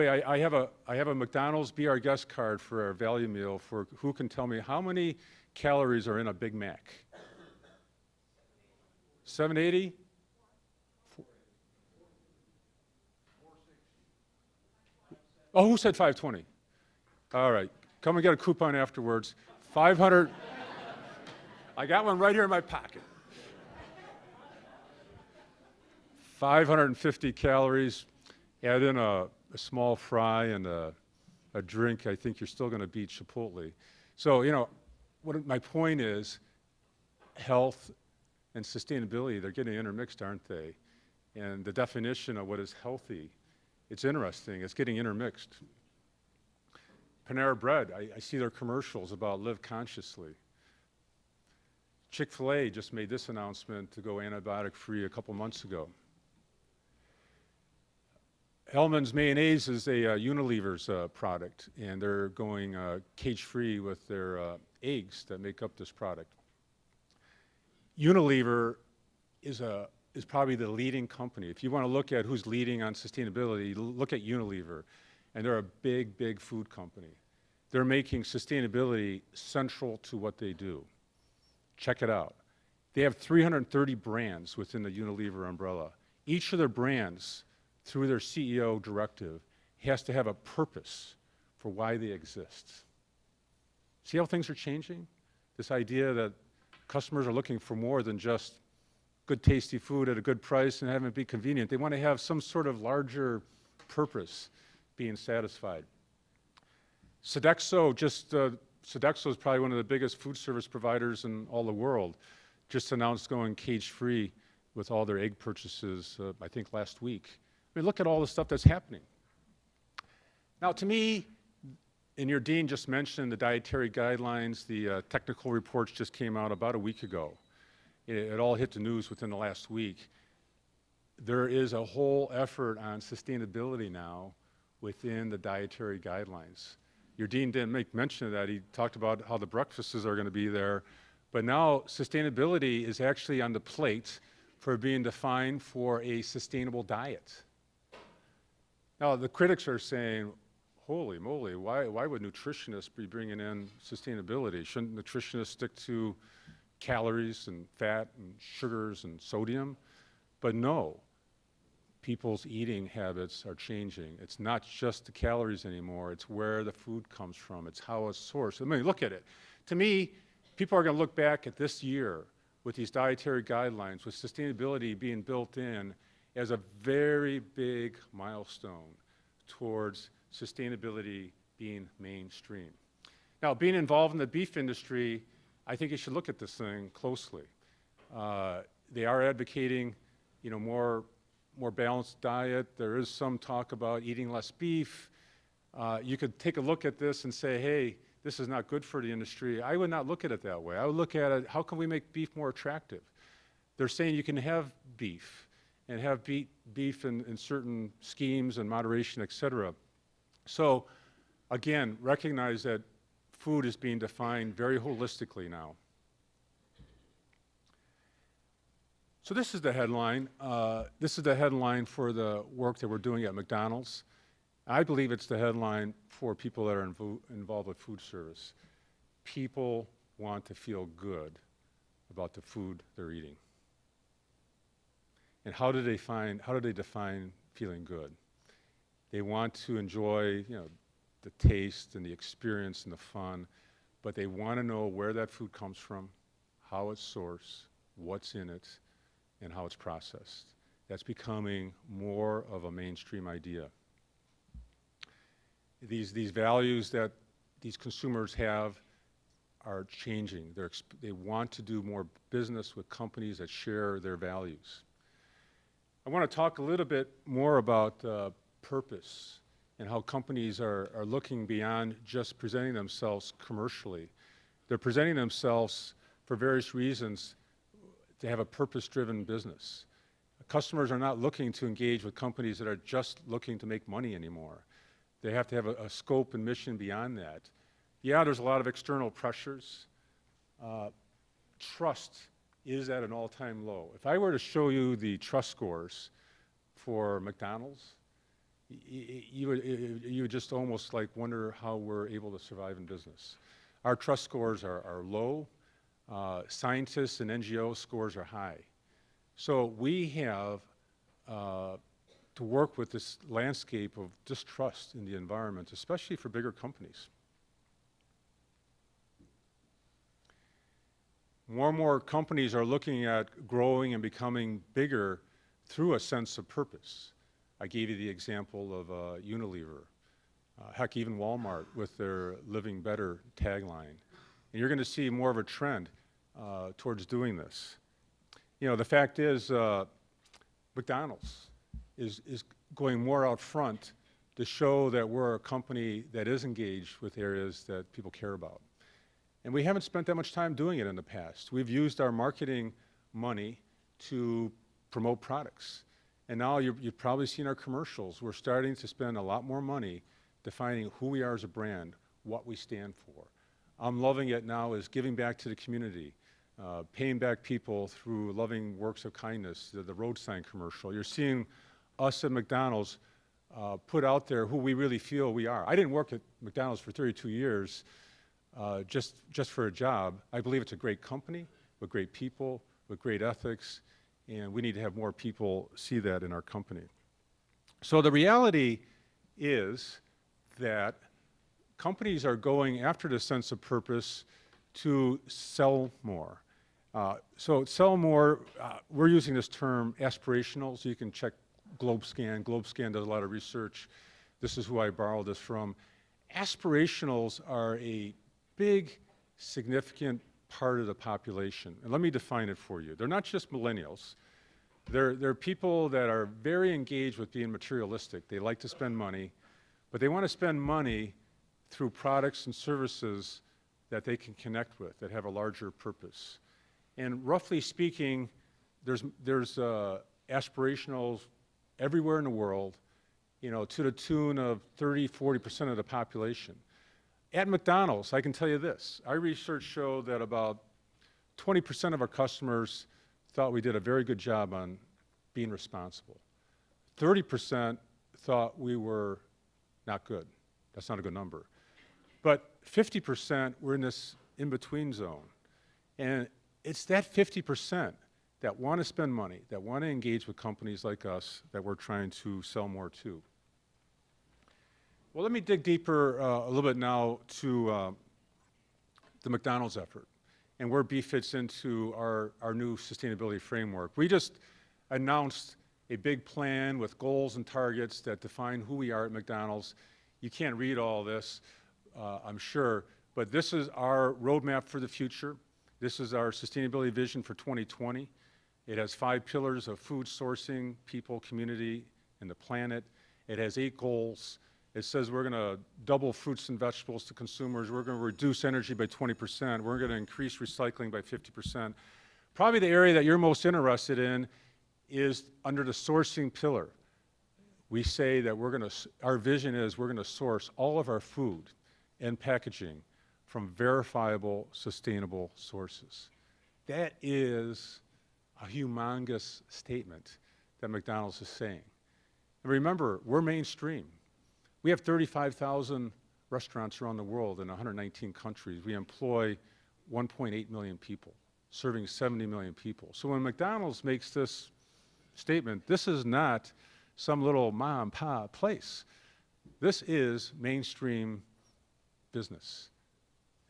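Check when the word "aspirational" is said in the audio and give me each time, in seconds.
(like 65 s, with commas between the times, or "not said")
399 s, 406 s.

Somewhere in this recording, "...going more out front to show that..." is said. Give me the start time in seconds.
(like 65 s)
342 s.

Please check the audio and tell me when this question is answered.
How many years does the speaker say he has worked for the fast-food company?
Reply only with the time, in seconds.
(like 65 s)
376 s.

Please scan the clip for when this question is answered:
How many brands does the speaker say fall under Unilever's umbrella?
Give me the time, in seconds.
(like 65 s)
83 s.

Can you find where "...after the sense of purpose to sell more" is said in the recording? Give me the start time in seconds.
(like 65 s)
392 s.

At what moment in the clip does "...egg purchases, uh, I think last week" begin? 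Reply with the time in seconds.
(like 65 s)
115 s.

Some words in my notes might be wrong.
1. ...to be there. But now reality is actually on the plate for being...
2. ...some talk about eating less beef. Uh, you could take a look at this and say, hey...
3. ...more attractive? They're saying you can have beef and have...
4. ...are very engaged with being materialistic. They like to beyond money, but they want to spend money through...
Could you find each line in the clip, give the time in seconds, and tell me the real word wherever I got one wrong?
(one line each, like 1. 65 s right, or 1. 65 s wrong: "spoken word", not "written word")
1. 140 s wrong: "sustainability", not "reality"
2. 193 s right
3. 202 s right
4. 416 s wrong: "spend", not "beyond".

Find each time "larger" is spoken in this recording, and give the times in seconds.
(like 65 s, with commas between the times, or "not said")
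102 s, 425 s.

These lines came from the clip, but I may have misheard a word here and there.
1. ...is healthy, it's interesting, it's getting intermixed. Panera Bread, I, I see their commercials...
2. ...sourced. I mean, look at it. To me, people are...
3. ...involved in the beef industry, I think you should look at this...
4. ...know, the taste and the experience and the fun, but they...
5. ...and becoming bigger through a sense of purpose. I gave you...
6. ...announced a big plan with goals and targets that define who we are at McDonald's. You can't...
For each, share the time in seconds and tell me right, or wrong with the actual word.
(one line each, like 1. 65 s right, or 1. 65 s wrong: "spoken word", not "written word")
1. 42 s right
2. 168 s right
3. 183 s right
4. 240 s right
5. 323 s right
6. 474 s right.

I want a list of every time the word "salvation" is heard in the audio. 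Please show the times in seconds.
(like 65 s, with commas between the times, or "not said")
not said.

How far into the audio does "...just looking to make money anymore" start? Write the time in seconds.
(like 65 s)
282 s.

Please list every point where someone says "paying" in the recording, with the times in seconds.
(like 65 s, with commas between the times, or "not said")
366 s.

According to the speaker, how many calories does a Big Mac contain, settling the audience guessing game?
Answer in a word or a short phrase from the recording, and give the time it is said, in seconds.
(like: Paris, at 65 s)
550, at 26 s.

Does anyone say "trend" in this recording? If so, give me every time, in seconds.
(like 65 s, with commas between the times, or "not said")
335 s.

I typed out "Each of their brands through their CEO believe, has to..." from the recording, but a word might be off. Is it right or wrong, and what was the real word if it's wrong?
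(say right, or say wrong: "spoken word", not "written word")
wrong: "directive", not "believe".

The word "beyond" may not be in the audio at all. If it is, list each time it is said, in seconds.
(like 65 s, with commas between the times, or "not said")
271 s, 286 s.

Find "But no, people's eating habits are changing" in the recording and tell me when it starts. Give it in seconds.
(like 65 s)
160 s.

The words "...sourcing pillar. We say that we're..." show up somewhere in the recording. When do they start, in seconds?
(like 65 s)
505 s.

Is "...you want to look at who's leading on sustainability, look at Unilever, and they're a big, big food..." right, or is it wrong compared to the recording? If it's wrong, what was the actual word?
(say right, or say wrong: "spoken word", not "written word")
right.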